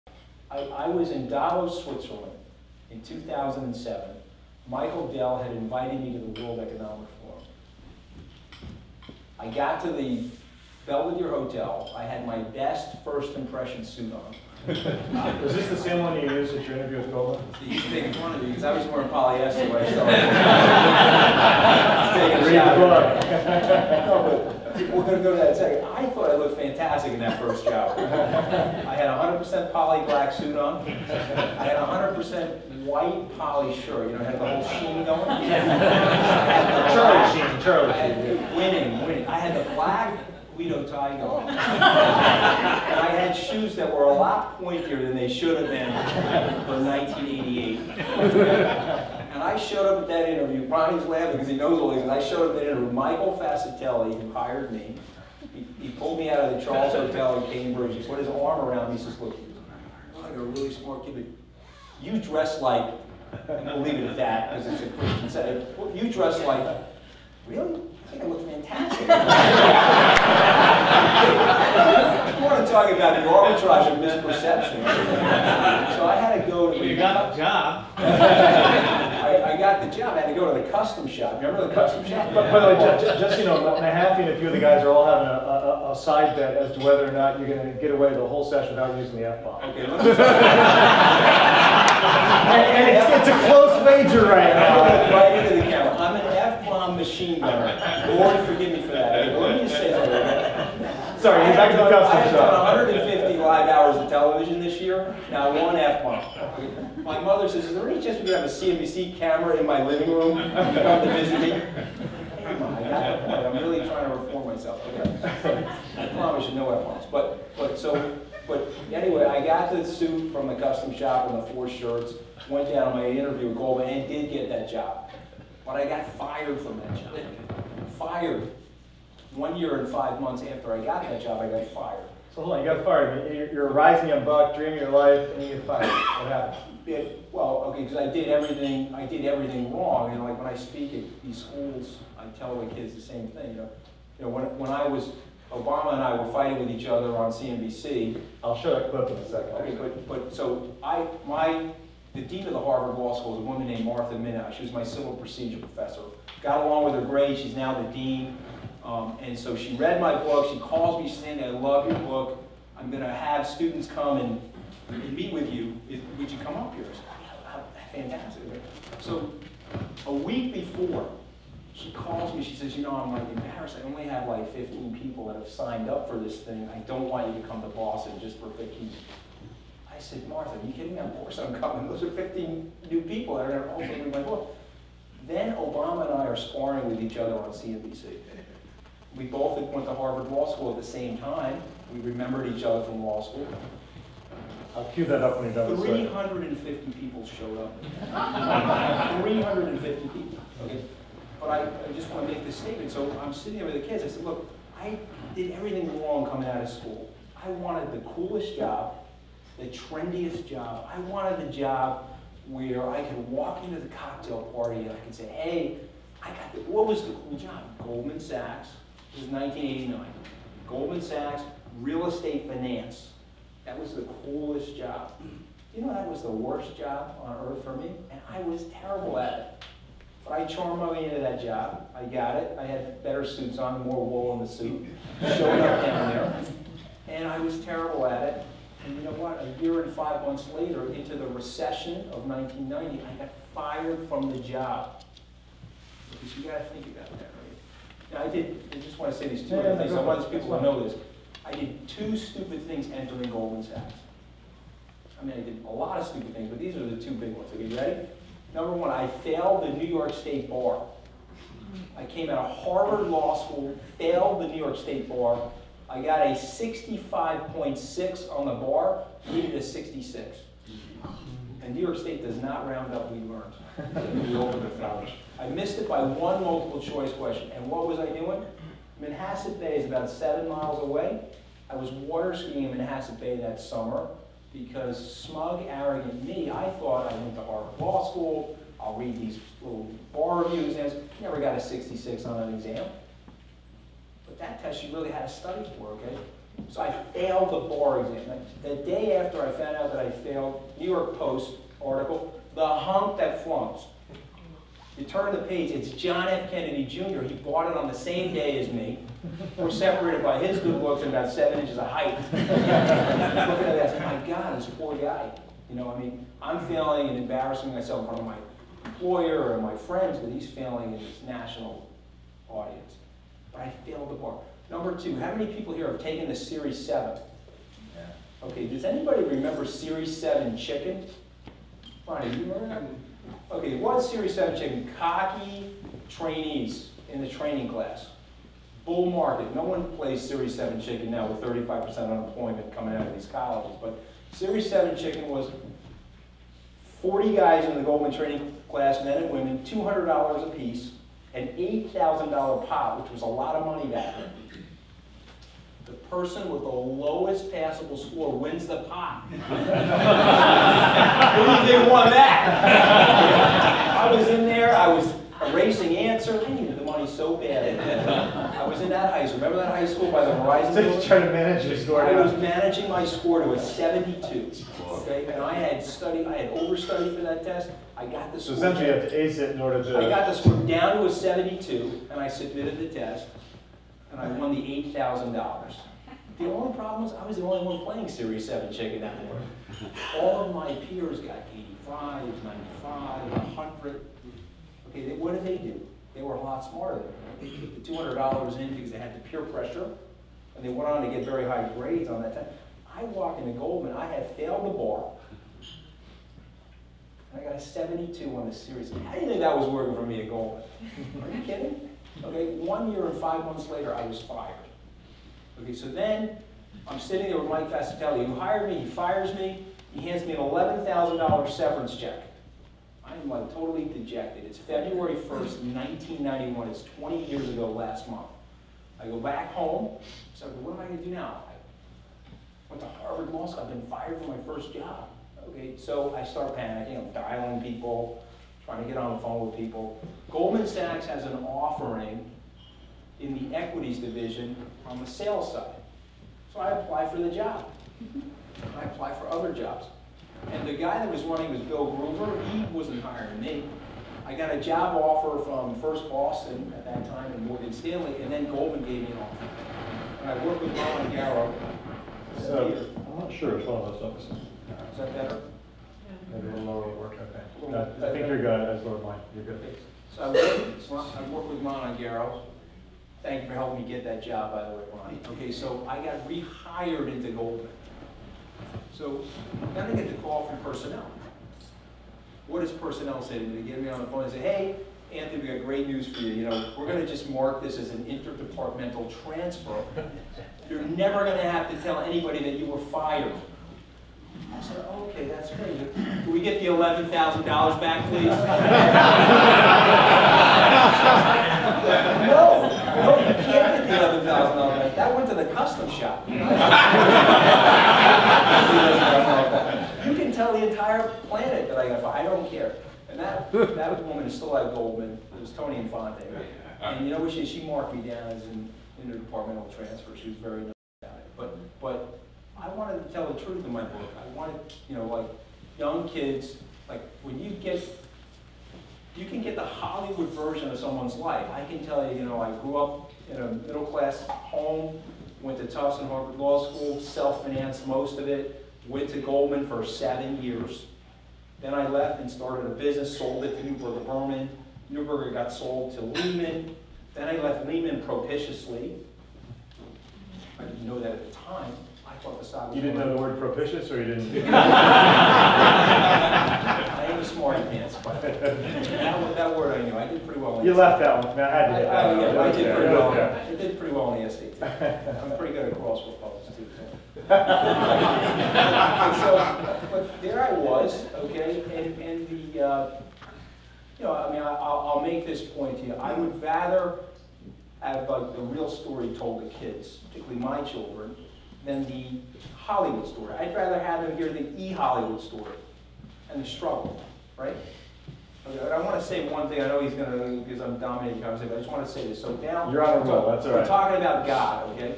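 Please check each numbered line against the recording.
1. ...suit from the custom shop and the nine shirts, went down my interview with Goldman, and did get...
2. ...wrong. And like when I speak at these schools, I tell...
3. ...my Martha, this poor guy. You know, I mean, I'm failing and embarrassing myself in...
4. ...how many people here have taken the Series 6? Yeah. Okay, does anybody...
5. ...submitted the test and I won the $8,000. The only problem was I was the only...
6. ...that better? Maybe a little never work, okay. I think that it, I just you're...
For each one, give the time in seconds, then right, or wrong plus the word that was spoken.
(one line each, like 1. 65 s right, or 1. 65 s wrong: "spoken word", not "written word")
1. 119 s wrong: "four", not "nine"
2. 139 s right
3. 313 s wrong: "God", not "Martha"
4. 325 s wrong: "7", not "6"
5. 382 s right
6. 464 s wrong: "lower", not "never".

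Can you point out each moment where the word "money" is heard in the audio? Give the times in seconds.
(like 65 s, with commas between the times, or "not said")
353 s, 366 s.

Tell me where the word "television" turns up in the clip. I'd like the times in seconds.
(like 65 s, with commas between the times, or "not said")
104 s.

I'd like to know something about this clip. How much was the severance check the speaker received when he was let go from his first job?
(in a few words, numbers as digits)
$11,000.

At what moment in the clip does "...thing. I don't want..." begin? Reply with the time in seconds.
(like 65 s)
176 s.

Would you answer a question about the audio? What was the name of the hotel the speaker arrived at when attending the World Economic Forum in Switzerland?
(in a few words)
Belvedere Hotel.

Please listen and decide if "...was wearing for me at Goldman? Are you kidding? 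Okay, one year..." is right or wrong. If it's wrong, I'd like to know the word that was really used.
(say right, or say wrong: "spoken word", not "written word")
wrong: "working", not "wearing".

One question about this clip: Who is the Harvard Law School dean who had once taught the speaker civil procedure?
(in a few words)
Martha Minow.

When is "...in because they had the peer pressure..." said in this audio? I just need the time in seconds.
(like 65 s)
398 s.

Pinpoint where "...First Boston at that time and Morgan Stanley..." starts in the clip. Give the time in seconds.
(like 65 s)
455 s.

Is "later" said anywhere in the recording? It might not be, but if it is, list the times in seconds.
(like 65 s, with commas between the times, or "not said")
240 s, 413 s.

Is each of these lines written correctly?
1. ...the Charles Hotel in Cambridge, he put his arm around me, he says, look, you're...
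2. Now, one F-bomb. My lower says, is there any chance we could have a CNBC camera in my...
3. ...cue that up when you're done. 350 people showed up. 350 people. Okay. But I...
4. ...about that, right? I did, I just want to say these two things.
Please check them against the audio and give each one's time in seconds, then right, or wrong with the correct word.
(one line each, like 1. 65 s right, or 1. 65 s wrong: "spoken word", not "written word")
1. 56 s right
2. 105 s wrong: "mother", not "lower"
3. 194 s right
4. 246 s right.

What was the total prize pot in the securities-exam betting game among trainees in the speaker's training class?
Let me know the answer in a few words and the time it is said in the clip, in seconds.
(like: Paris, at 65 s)
$8,000, at 351 s.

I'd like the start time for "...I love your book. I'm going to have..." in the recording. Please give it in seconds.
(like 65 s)
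161 s.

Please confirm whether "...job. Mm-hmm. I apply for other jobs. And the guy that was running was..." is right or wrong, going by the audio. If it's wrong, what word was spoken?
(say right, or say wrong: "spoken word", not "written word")
right.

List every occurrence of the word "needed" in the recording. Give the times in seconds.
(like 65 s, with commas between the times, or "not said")
269 s, 366 s.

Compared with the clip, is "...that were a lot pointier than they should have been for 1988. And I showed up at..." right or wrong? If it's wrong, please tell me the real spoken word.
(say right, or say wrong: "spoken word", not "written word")
right.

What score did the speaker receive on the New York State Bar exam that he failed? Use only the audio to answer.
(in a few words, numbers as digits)
65.6.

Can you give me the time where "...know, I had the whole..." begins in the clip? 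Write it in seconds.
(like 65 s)
34 s.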